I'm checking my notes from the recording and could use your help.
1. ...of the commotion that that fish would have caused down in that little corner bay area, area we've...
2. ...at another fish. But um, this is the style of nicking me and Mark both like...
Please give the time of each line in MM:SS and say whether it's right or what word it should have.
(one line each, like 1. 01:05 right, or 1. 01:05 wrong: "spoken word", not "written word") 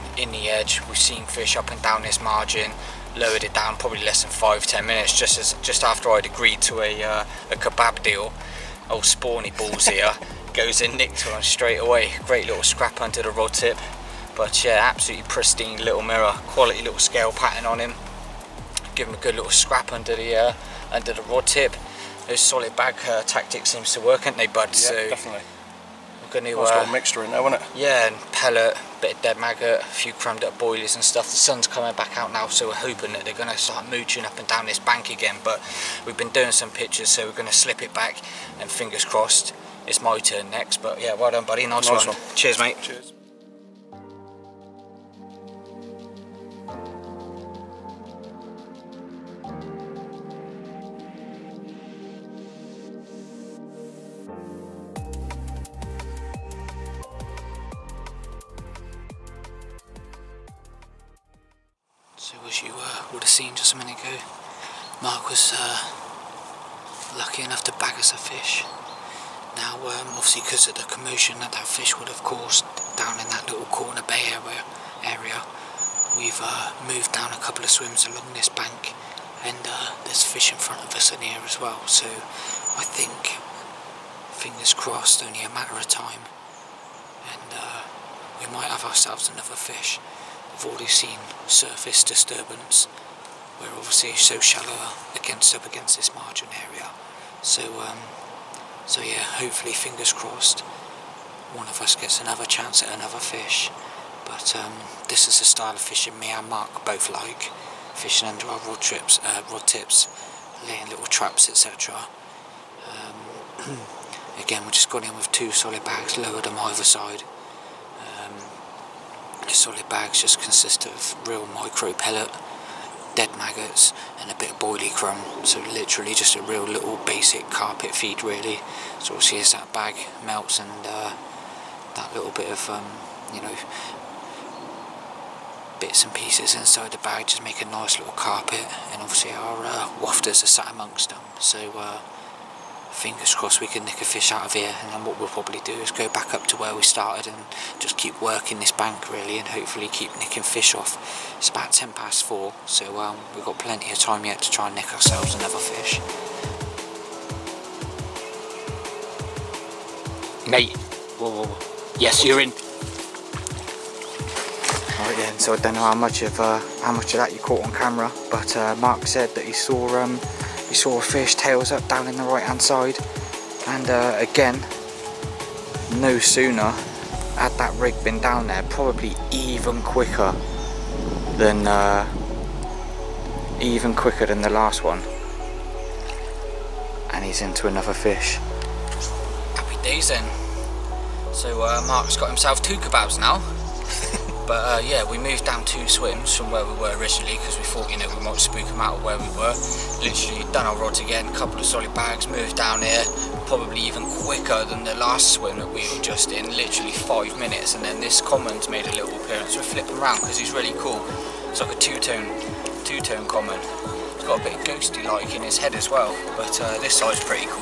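1. 01:10 right
2. 01:42 wrong: "fishing", not "nicking".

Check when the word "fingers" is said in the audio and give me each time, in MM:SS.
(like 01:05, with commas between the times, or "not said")
00:38, 01:24, 01:39, 02:22.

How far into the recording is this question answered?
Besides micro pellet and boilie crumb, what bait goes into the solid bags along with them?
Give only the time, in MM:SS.
02:03.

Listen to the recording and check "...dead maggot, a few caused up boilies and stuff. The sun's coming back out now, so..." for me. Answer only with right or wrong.
wrong.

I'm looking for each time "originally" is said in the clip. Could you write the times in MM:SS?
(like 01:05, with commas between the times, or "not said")
03:16.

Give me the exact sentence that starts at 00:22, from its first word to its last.
Those solid bag uh, tactics seems to work, aren't they, bud?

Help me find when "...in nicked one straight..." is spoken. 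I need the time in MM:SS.
00:10.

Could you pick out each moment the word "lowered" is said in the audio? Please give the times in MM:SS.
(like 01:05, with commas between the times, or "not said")
00:03, 01:56.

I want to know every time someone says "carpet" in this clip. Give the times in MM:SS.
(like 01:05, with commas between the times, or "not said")
02:07, 02:18.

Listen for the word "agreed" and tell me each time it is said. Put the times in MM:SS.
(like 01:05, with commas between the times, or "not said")
00:06.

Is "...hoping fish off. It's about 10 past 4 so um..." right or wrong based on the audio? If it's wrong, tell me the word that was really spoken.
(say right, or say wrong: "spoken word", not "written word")
wrong: "nicking", not "hoping".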